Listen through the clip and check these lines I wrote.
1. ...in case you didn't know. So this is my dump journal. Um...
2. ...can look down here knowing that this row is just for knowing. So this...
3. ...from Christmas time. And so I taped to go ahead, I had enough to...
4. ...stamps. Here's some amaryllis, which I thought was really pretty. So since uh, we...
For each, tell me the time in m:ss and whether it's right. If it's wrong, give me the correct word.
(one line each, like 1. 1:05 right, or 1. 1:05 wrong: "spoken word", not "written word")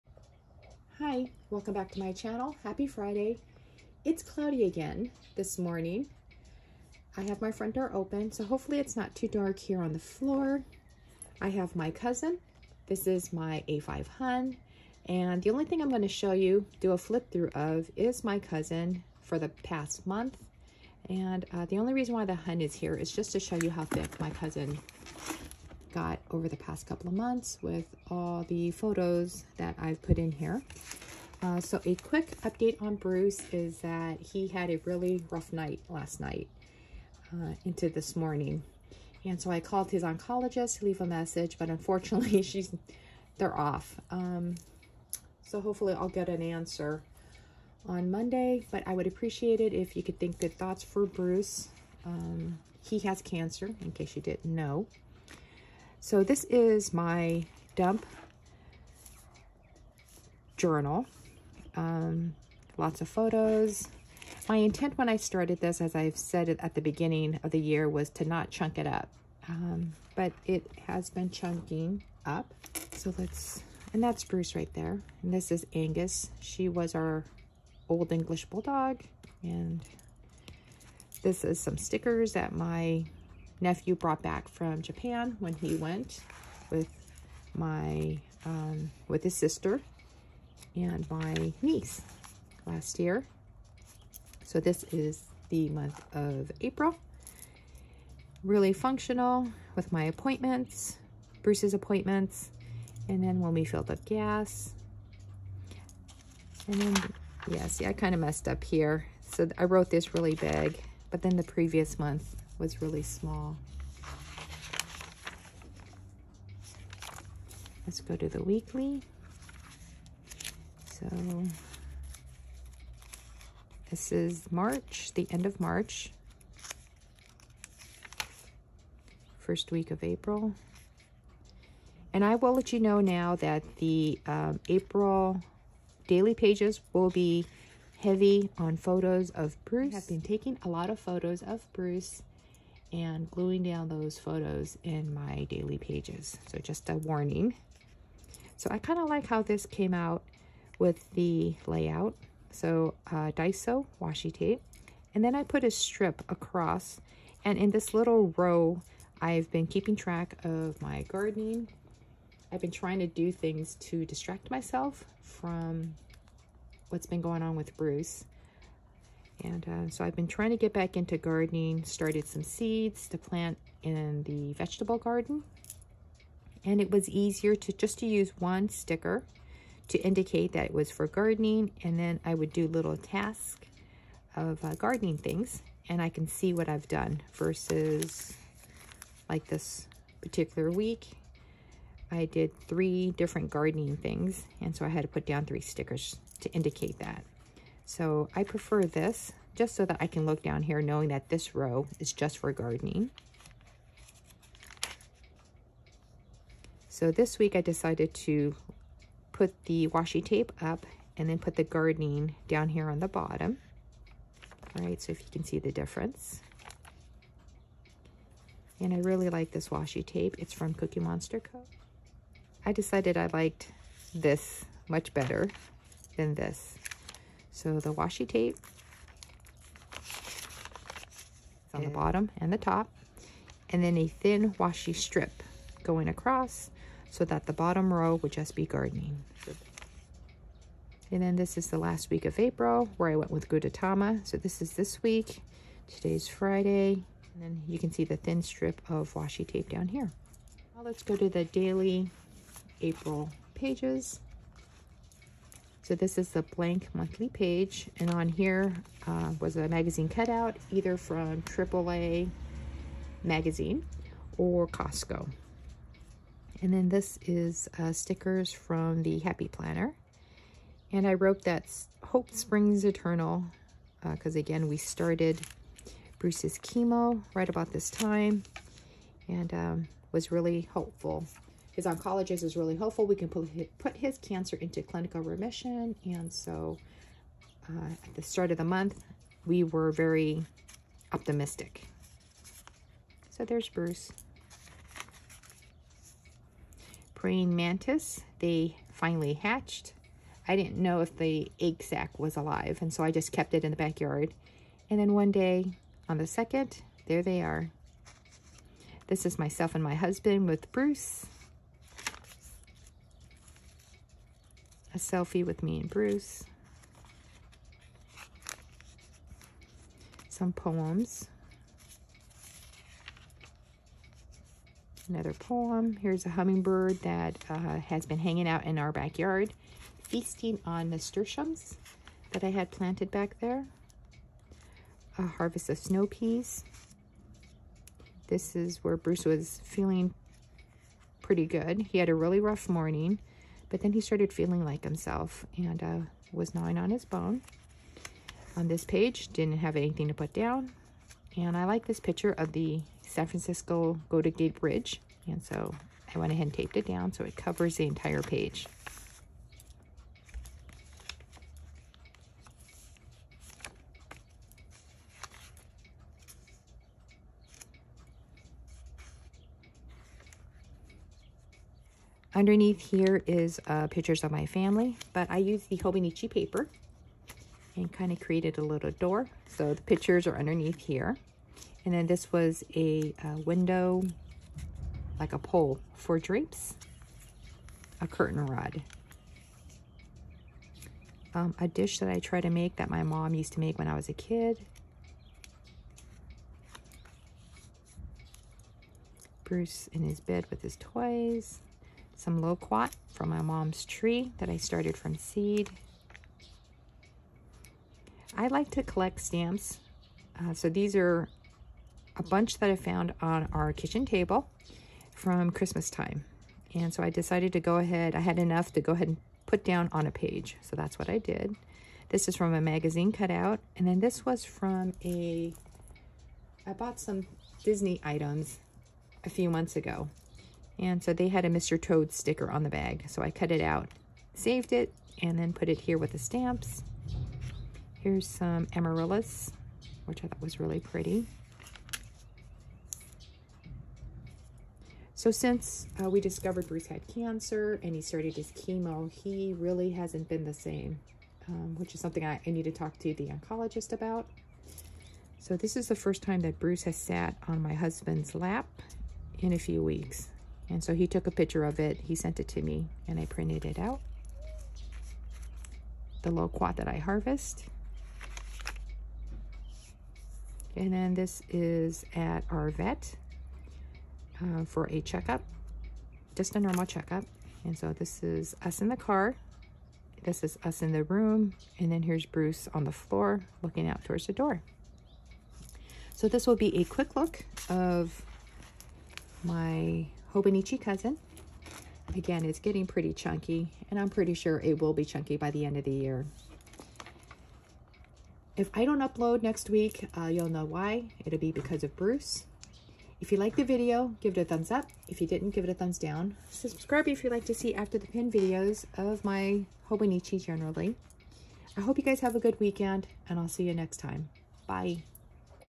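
1. 0:53 right
2. 3:20 wrong: "gardening", not "knowing"
3. 6:55 wrong: "decided", not "taped"
4. 7:16 right.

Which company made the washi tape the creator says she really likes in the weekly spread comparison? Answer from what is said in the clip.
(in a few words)
Cookie Monster Co.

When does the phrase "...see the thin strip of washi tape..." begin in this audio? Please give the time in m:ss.
4:07.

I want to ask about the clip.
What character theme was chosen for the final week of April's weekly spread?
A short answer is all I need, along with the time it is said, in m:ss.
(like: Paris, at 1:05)
Gudetama, at 4:03.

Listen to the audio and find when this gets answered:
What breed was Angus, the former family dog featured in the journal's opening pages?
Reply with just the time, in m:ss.
1:17.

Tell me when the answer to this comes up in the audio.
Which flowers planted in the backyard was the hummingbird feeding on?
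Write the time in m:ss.
5:30.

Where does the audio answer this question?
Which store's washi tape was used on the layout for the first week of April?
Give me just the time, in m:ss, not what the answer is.
2:33.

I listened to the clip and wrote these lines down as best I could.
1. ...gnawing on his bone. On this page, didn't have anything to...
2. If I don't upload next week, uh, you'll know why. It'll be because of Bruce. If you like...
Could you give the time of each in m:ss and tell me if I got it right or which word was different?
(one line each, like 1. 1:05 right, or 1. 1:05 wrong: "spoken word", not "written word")
1. 5:46 right
2. 8:18 right.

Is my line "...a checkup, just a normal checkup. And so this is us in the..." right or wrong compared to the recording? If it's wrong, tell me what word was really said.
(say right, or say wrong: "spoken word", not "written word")
right.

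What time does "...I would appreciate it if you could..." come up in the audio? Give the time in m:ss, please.
0:48.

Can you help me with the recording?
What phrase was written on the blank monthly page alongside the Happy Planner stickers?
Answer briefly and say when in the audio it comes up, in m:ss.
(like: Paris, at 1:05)
Hope Springs Eternal, at 4:32.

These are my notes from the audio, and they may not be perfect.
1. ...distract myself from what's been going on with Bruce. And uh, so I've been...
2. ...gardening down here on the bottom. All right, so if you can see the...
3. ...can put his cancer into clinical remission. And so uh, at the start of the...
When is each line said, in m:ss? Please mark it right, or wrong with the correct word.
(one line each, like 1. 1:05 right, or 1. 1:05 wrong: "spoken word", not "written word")
1. 2:44 right
2. 3:31 right
3. 4:43 right.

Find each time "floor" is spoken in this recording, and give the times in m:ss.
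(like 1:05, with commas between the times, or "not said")
0:09, 8:02.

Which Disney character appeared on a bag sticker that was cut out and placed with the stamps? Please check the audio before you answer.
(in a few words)
Mr. Toad.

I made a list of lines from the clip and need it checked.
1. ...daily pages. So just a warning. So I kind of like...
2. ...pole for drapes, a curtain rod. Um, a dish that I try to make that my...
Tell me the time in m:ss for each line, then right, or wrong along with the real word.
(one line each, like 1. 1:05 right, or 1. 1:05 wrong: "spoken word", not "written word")
1. 2:25 right
2. 6:25 right.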